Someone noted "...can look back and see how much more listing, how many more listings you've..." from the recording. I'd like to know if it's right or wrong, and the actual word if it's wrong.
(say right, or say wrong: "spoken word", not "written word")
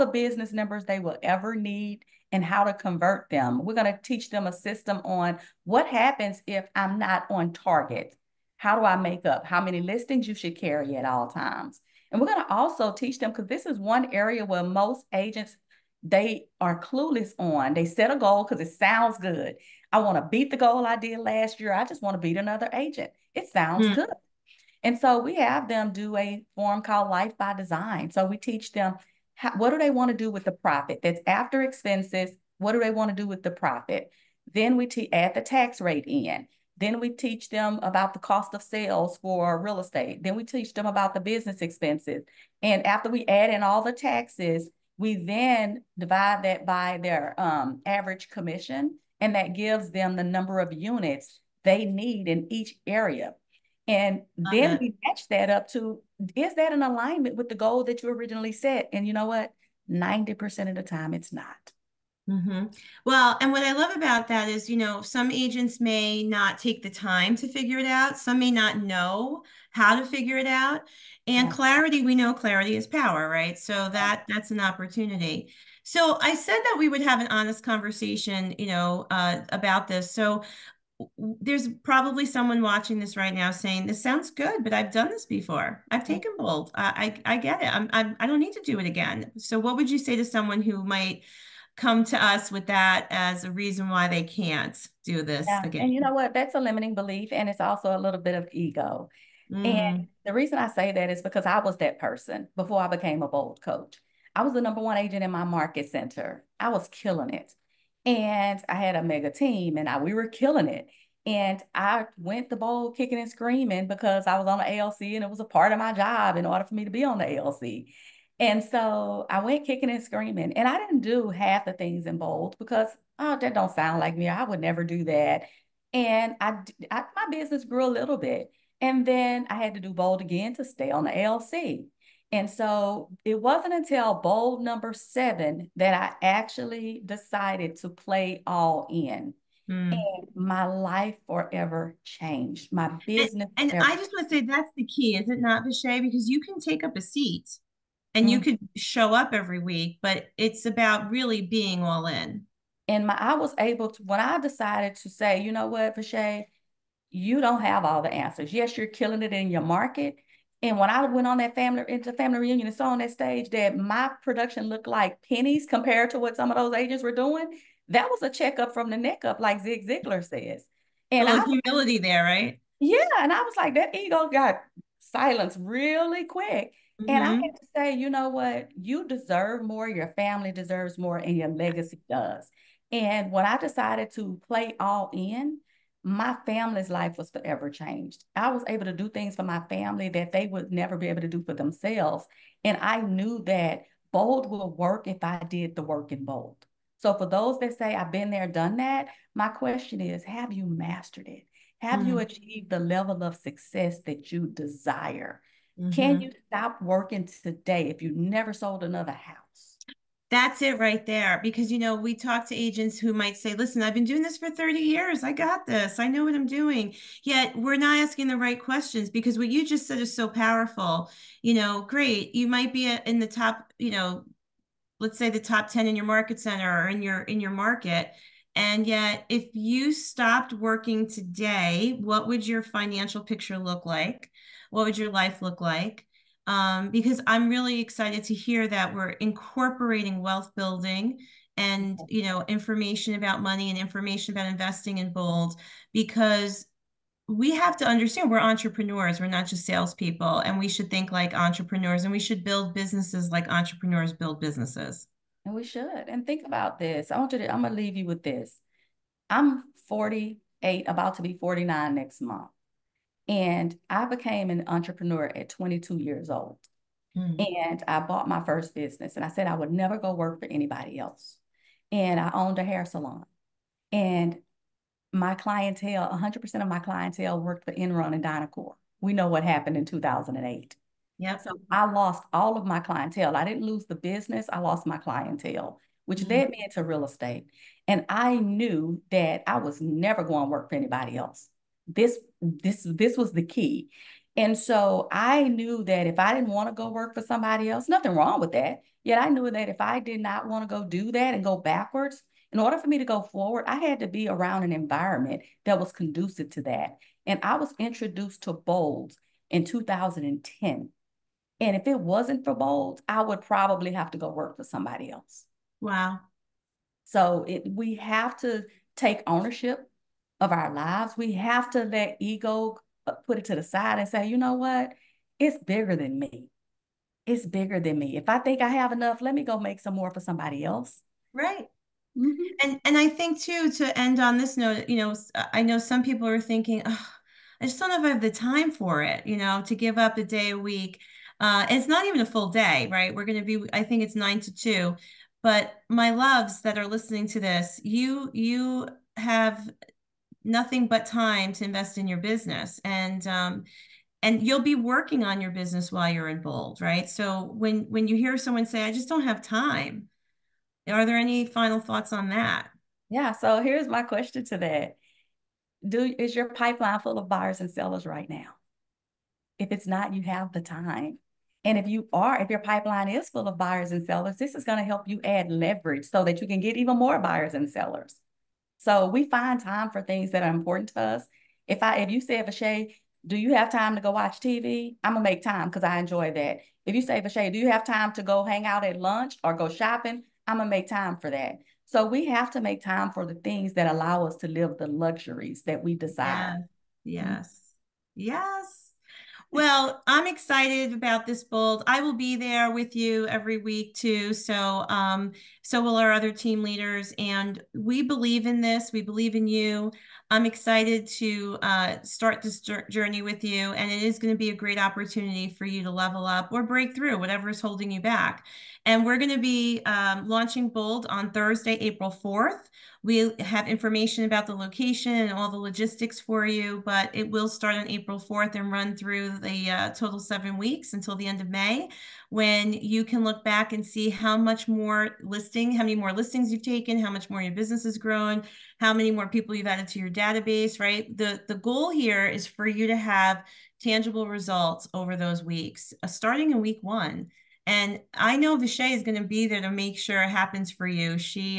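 right.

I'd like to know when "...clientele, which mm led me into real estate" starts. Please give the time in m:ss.
4:44.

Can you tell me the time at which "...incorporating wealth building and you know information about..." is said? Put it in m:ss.
3:59.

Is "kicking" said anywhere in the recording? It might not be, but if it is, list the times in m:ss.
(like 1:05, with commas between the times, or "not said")
1:52, 1:59.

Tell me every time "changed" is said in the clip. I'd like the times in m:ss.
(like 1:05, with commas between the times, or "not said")
2:22, 3:07.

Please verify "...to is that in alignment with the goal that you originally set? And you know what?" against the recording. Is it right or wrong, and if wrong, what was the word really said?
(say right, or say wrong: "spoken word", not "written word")
right.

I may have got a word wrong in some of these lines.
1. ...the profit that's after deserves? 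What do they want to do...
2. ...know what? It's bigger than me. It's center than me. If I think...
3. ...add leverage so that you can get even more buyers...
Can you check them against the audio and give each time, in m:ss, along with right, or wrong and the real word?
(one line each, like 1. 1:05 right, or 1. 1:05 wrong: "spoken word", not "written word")
1. 0:30 wrong: "expenses", not "deserves"
2. 5:24 wrong: "bigger", not "center"
3. 6:15 right.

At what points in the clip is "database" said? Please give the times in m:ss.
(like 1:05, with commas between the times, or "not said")
7:20.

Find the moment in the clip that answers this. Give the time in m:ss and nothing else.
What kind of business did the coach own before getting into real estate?
4:32.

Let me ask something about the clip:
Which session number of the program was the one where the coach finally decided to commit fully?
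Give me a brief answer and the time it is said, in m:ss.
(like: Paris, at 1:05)
7, at 2:14.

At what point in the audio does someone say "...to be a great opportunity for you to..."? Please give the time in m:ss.
6:54.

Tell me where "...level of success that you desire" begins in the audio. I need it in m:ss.
3:22.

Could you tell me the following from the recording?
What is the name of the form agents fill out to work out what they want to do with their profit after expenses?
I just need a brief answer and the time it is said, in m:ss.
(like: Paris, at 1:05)
Life by Design, at 0:27.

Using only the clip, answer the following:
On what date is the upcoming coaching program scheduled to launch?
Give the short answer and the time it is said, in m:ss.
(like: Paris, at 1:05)
Thursday, April 4th, at 7:01.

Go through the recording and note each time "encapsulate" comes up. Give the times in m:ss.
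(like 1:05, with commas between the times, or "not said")
not said.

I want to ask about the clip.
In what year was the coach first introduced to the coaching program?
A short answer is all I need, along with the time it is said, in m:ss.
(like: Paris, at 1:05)
2010, at 5:09.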